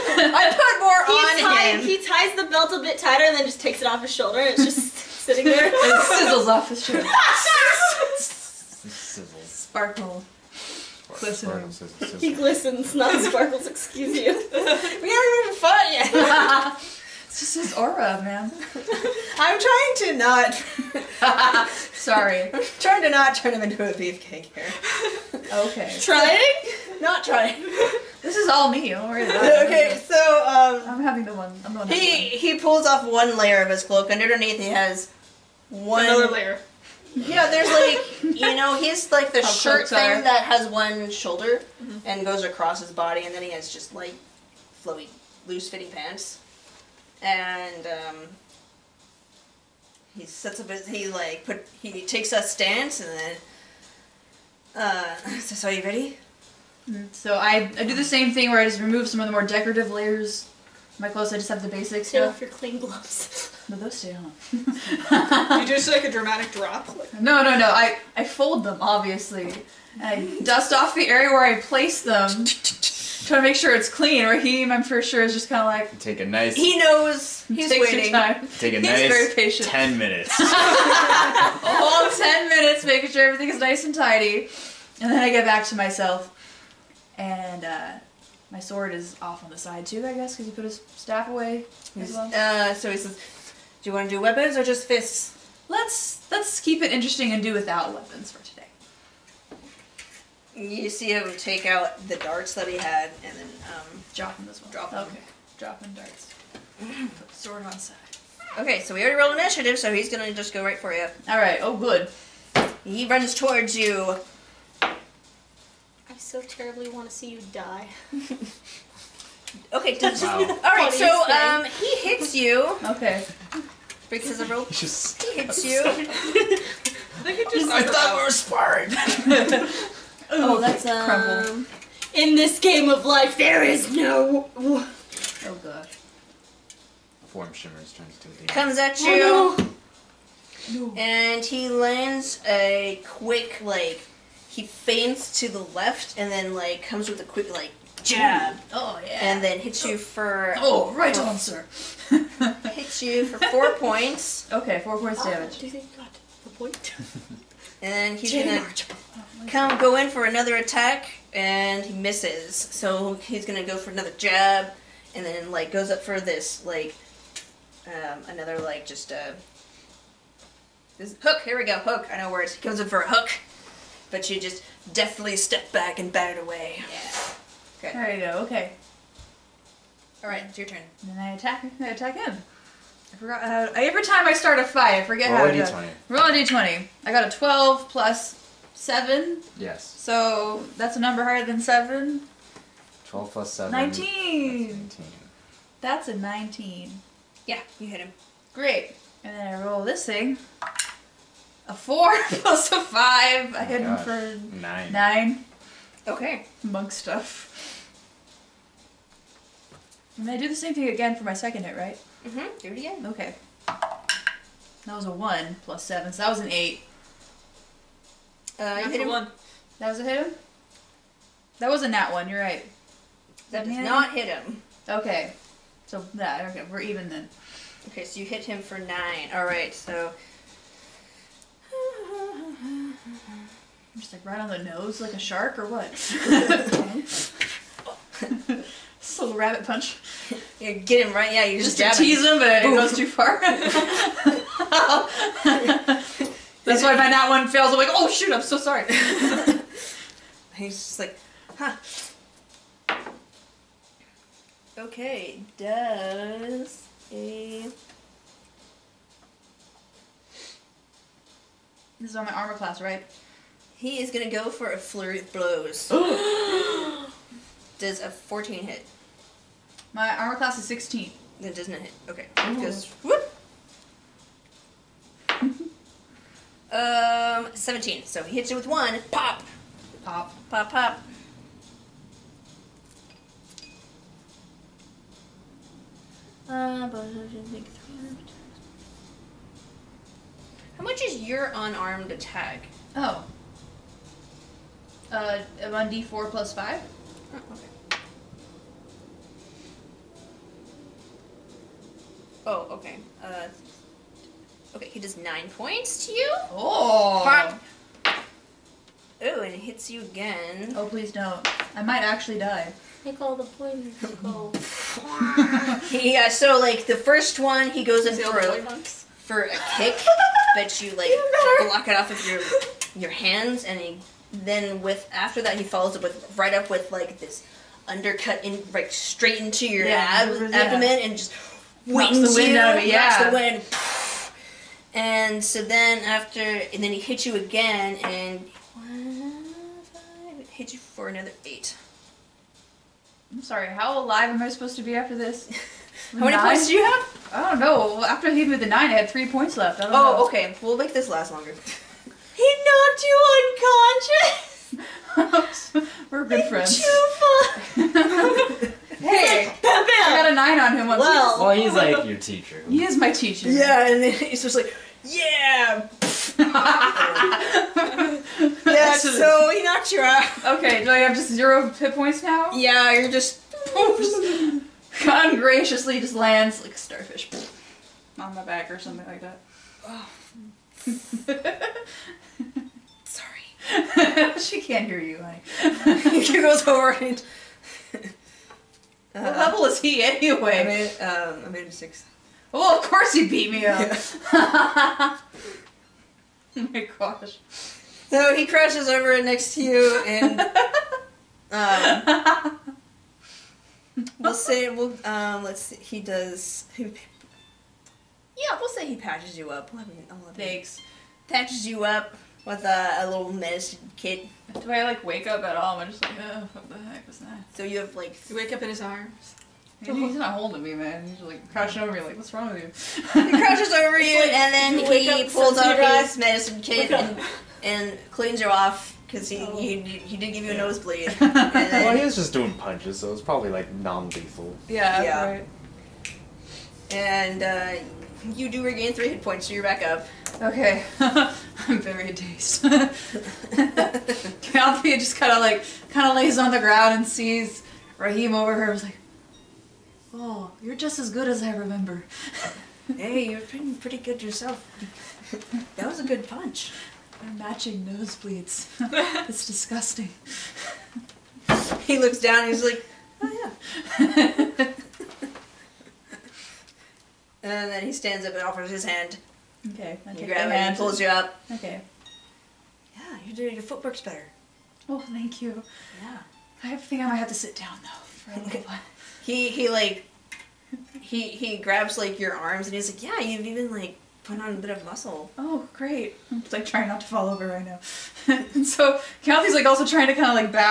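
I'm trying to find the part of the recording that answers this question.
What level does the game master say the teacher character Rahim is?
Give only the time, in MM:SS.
06:31.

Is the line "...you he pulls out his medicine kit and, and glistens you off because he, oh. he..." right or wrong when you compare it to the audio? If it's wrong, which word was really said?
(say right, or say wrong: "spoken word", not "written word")
wrong: "cleans", not "glistens".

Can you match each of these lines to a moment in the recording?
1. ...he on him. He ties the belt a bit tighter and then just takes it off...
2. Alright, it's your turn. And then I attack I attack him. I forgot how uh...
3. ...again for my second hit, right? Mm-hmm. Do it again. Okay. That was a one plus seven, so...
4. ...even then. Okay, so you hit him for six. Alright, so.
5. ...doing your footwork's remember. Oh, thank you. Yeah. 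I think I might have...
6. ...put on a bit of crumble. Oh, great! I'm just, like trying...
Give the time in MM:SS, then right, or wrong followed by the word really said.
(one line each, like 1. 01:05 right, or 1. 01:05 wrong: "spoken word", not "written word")
1. 00:01 right
2. 03:00 right
3. 03:30 right
4. 03:46 wrong: "nine", not "six"
5. 07:53 wrong: "better", not "remember"
6. 08:04 wrong: "muscle", not "crumble".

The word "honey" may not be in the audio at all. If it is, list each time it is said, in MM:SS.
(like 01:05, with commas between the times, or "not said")
06:25.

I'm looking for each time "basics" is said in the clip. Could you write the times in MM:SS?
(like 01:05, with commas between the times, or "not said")
01:01.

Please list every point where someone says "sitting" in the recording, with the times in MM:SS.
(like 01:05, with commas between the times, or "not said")
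00:04.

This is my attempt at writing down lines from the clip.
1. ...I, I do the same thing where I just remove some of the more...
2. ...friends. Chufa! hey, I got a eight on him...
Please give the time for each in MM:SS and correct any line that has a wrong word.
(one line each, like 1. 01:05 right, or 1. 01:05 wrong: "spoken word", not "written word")
1. 00:57 right
2. 05:56 wrong: "nine", not "eight".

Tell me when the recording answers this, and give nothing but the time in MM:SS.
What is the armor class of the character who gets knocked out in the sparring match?
04:30.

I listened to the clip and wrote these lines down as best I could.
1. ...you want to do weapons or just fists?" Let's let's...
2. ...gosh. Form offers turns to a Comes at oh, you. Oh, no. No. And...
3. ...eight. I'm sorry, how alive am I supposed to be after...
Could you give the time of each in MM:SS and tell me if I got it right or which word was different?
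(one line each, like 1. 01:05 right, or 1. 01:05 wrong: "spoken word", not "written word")
1. 01:33 right
2. 02:15 wrong: "shimmers", not "offers"
3. 05:41 right.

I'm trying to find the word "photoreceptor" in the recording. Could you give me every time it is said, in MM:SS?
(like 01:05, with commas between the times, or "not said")
not said.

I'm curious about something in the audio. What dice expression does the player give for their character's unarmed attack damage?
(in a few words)
D4 plus 5.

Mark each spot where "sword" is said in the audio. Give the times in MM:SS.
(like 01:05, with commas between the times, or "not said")
01:28, 01:47.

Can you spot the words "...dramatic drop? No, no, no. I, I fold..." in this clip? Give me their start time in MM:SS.
01:06.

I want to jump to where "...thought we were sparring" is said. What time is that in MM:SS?
02:07.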